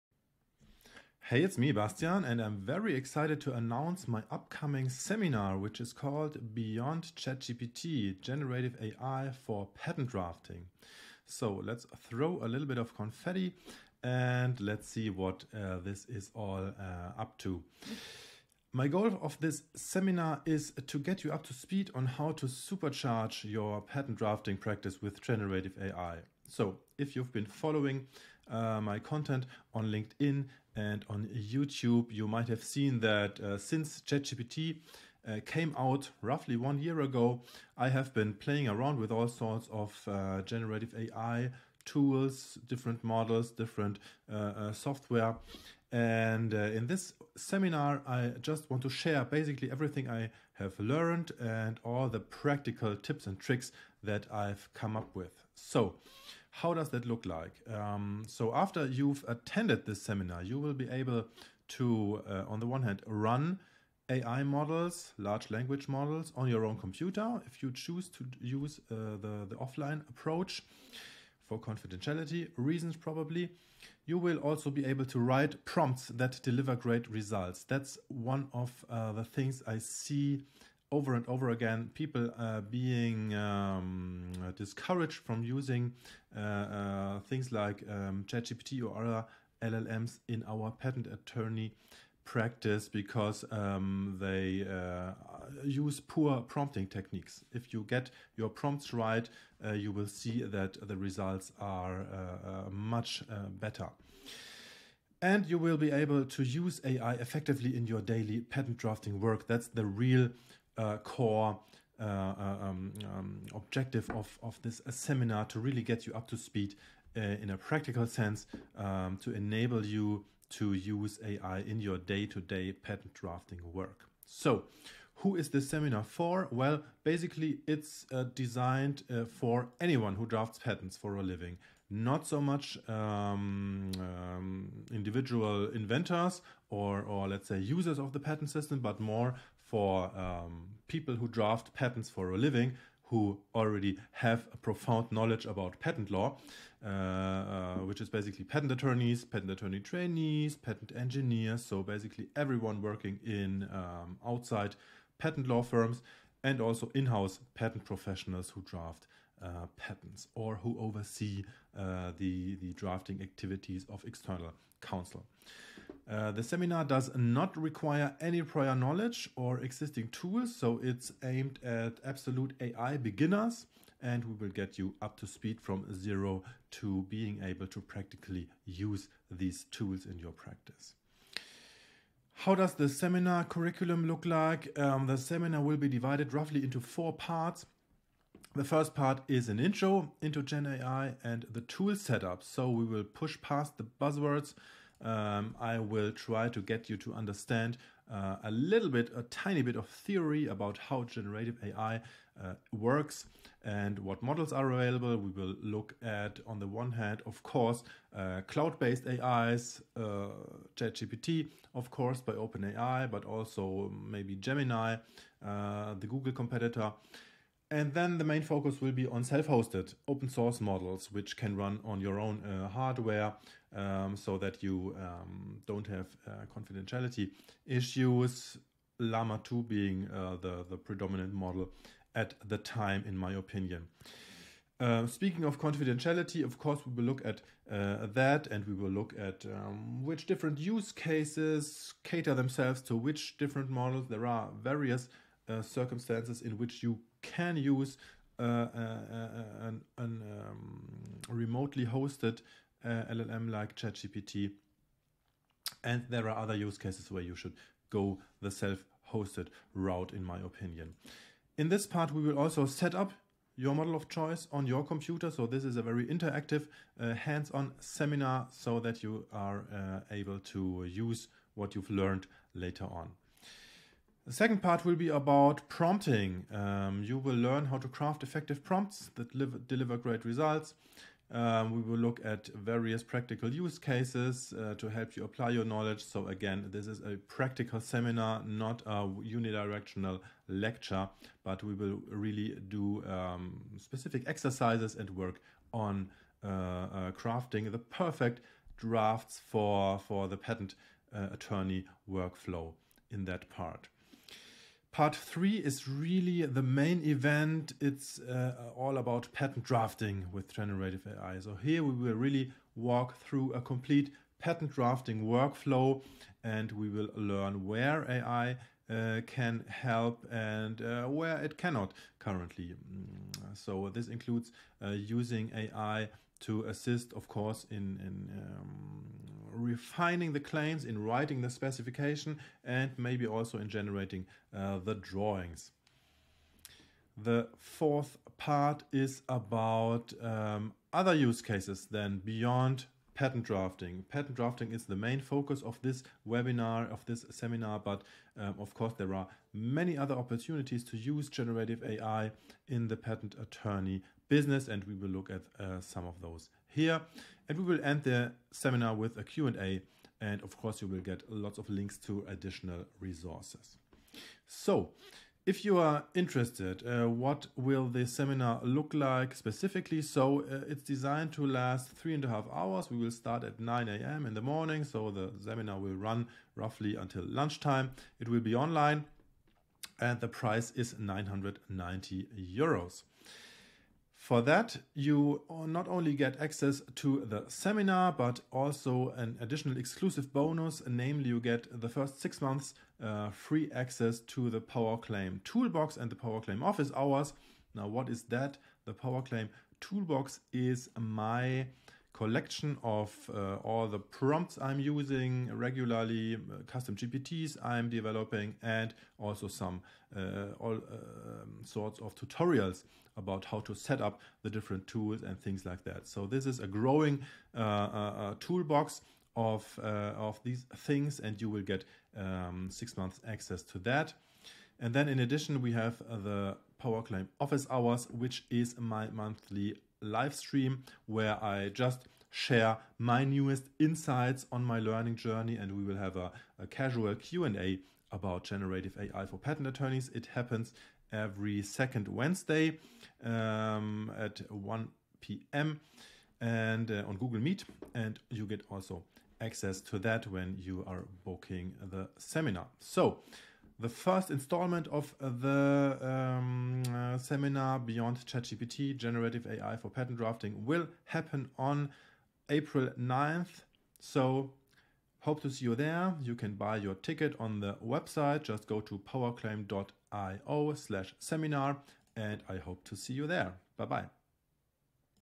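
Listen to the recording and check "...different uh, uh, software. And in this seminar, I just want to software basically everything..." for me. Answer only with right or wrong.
wrong.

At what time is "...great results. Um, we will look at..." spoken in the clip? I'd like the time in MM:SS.
04:39.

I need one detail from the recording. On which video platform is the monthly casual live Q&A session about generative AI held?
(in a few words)
Google Meet.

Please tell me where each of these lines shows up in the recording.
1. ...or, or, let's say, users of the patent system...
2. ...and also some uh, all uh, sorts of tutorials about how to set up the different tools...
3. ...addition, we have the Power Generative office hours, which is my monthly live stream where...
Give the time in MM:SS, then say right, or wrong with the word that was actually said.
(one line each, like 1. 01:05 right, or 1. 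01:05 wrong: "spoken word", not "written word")
1. 02:16 right
2. 06:48 right
3. 07:05 wrong: "Claim", not "Generative".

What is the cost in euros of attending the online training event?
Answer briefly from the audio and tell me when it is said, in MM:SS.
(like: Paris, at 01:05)
990 euros, at 06:20.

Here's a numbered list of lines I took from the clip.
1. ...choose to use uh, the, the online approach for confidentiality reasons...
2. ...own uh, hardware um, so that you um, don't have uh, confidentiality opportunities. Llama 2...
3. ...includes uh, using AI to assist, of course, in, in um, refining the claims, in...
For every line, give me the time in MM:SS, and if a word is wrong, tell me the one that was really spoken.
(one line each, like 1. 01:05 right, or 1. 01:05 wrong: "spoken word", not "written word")
1. 01:07 wrong: "offline", not "online"
2. 03:42 wrong: "issues", not "opportunities"
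3. 05:24 right.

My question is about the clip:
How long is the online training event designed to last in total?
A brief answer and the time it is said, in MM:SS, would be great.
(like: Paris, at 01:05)
3.5 hours, at 06:11.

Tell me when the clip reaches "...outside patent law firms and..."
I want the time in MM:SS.
02:34.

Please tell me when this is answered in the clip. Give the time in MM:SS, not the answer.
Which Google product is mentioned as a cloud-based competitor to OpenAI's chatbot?
03:34.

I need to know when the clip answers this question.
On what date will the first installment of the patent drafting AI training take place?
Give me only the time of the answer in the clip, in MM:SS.
07:42.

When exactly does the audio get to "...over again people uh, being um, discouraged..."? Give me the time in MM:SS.
01:21.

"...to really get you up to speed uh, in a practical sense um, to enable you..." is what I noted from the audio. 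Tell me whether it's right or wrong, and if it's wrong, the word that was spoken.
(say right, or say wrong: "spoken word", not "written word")
right.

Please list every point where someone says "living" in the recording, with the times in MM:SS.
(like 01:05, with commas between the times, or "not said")
02:11, 02:22.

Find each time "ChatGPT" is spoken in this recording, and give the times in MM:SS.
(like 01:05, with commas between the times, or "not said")
00:07, 00:34, 01:28, 03:30, 04:13, 07:38.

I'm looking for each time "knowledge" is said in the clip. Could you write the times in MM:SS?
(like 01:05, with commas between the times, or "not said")
02:25, 02:48, 04:45.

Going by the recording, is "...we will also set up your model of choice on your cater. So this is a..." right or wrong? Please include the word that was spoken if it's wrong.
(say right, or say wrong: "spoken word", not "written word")
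wrong: "computer", not "cater".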